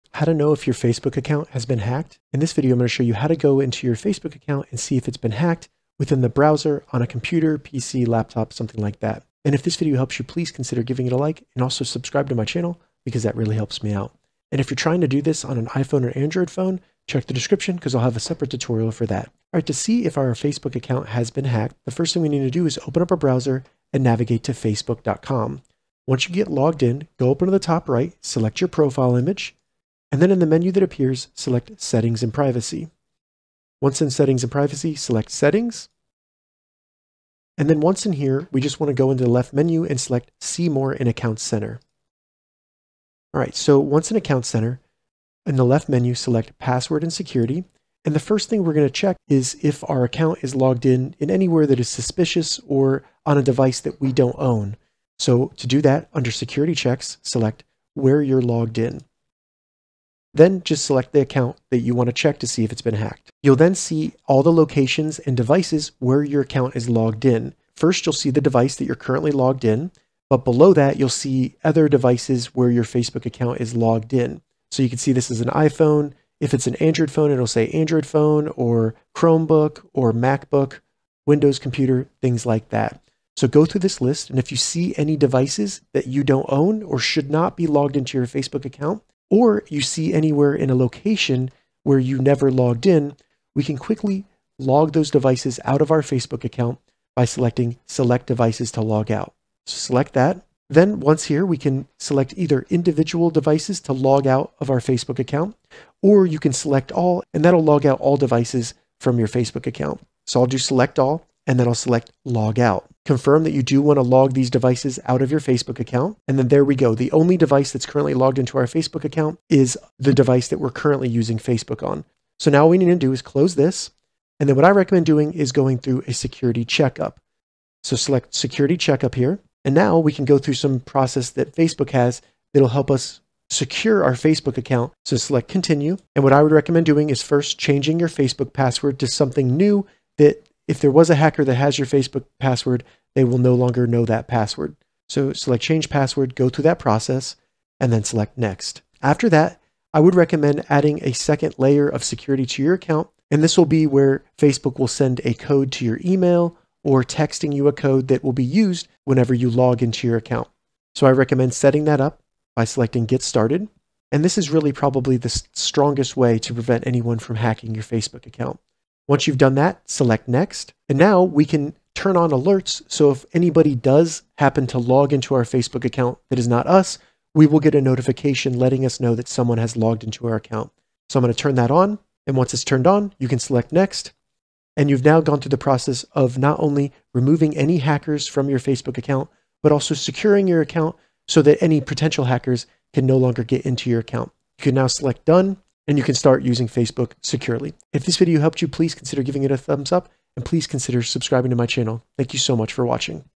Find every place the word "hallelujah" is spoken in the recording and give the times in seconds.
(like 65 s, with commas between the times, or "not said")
not said.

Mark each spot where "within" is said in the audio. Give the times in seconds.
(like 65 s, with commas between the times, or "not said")
5 s.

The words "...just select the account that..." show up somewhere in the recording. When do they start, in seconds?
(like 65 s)
60 s.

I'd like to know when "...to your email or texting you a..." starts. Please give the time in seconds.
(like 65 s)
155 s.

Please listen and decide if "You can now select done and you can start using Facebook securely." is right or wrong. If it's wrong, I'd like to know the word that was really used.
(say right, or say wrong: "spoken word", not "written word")
right.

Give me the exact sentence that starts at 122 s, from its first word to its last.
So now what we need to do is close this.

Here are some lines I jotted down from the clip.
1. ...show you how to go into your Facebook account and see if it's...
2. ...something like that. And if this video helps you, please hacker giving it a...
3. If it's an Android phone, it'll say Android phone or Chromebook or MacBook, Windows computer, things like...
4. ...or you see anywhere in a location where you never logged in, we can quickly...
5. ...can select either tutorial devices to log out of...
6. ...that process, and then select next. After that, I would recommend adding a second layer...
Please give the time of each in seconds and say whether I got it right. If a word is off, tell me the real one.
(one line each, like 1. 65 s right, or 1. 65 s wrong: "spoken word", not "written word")
1. 2 s right
2. 8 s wrong: "consider", not "hacker"
3. 76 s right
4. 89 s right
5. 101 s wrong: "individual", not "tutorial"
6. 146 s right.